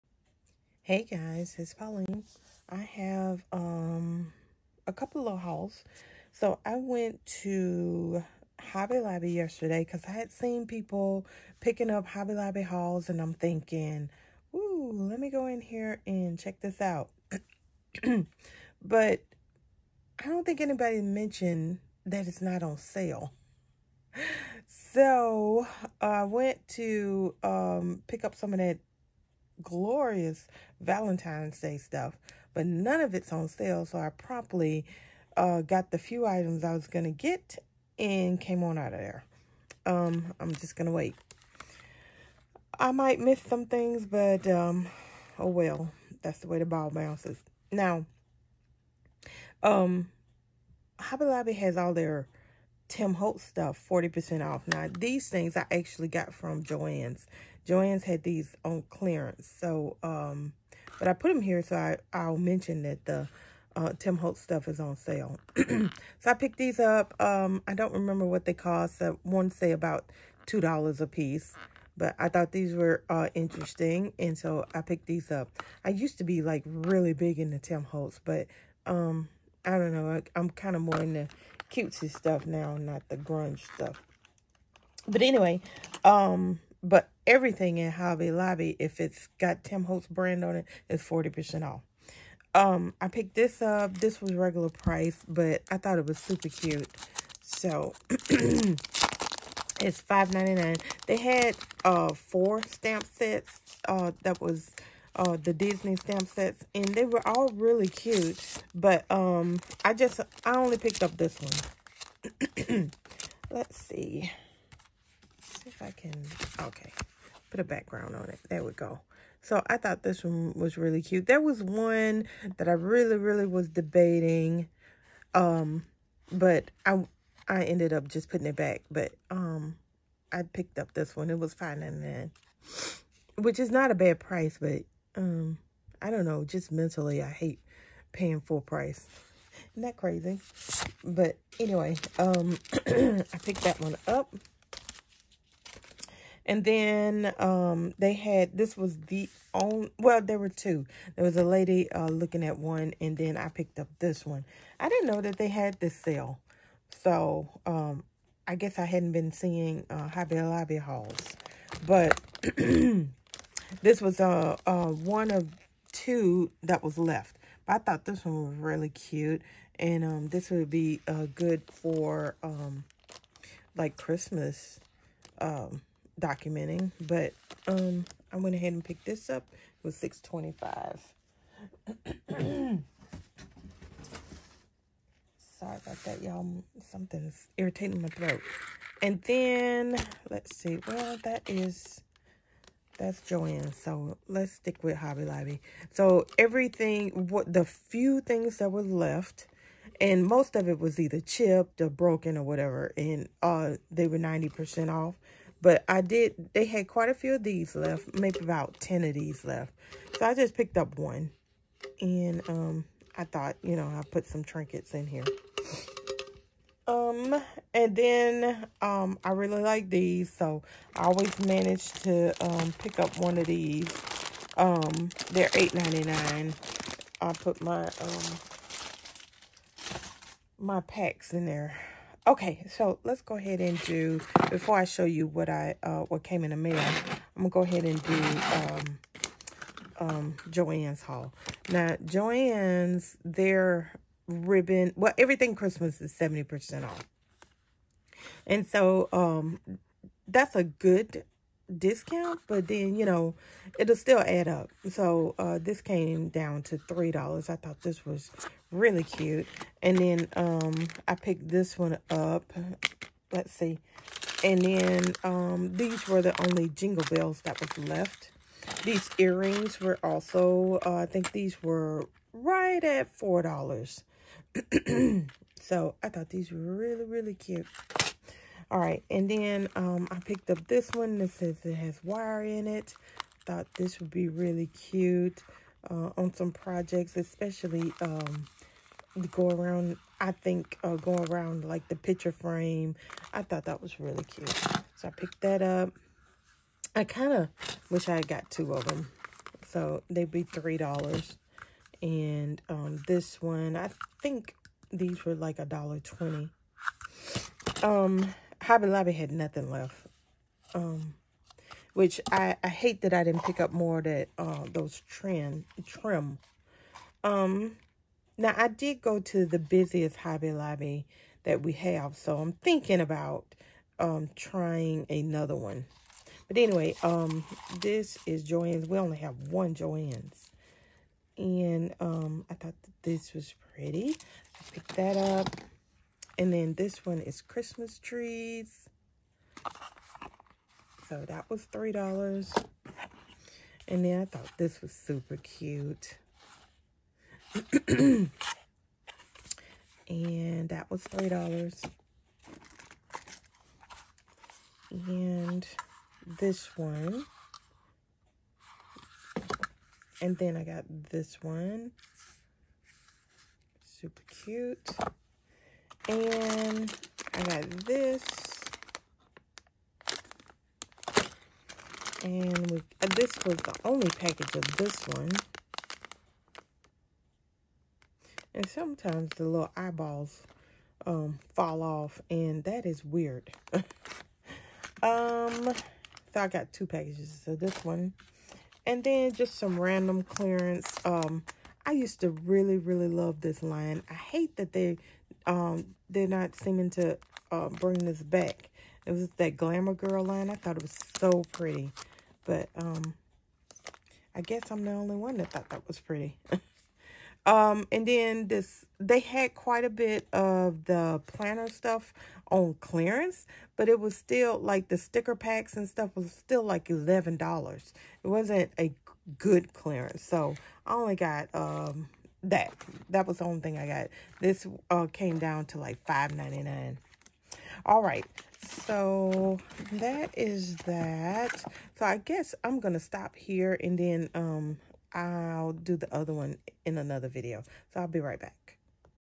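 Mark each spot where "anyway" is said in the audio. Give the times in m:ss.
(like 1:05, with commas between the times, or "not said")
1:25, 2:21, 5:26.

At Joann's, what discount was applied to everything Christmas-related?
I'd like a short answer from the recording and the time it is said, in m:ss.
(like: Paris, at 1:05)
70%, at 4:06.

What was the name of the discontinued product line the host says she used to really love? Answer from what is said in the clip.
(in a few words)
Glamour Girl.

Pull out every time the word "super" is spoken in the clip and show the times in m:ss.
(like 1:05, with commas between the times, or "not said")
1:36, 5:44, 6:03.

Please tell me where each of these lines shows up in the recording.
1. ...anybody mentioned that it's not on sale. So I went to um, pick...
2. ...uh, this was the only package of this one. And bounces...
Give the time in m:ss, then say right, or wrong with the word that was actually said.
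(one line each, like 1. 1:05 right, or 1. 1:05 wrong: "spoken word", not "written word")
1. 0:20 right
2. 6:13 wrong: "sometimes", not "bounces".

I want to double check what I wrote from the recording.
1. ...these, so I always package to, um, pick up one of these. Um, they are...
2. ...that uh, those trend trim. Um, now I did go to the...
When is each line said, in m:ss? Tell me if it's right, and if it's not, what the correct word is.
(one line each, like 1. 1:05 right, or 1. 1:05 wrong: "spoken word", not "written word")
1. 3:39 wrong: "manage", not "package"
2. 5:14 right.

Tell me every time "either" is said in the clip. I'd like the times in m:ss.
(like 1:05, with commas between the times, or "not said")
3:20.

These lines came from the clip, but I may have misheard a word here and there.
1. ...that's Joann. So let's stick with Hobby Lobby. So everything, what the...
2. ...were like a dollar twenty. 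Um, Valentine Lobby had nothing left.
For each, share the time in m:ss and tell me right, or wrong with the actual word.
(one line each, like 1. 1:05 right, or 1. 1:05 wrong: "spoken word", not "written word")
1. 3:13 right
2. 5:05 wrong: "Hobby", not "Valentine".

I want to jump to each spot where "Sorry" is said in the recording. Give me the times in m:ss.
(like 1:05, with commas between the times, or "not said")
3:05.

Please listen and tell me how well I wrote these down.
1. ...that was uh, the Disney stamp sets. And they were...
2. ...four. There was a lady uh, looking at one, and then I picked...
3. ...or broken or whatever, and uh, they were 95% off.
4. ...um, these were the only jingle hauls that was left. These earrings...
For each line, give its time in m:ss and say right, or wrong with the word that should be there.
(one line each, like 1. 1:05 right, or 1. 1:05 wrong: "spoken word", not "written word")
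1. 1:44 right
2. 2:30 wrong: "two", not "four"
3. 3:21 wrong: "90", not "95"
4. 4:25 wrong: "bells", not "hauls".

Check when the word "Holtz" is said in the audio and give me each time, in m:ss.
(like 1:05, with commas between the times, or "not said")
0:53, 1:04, 1:17, 1:29.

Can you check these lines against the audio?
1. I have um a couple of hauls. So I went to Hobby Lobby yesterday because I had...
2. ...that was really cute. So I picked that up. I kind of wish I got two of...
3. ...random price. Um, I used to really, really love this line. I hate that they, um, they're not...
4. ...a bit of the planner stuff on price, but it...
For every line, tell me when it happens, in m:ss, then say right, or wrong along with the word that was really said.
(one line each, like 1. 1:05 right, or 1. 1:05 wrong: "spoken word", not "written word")
1. 0:02 right
2. 4:53 right
3. 6:29 wrong: "clearance", not "price"
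4. 6:49 wrong: "clearance", not "price".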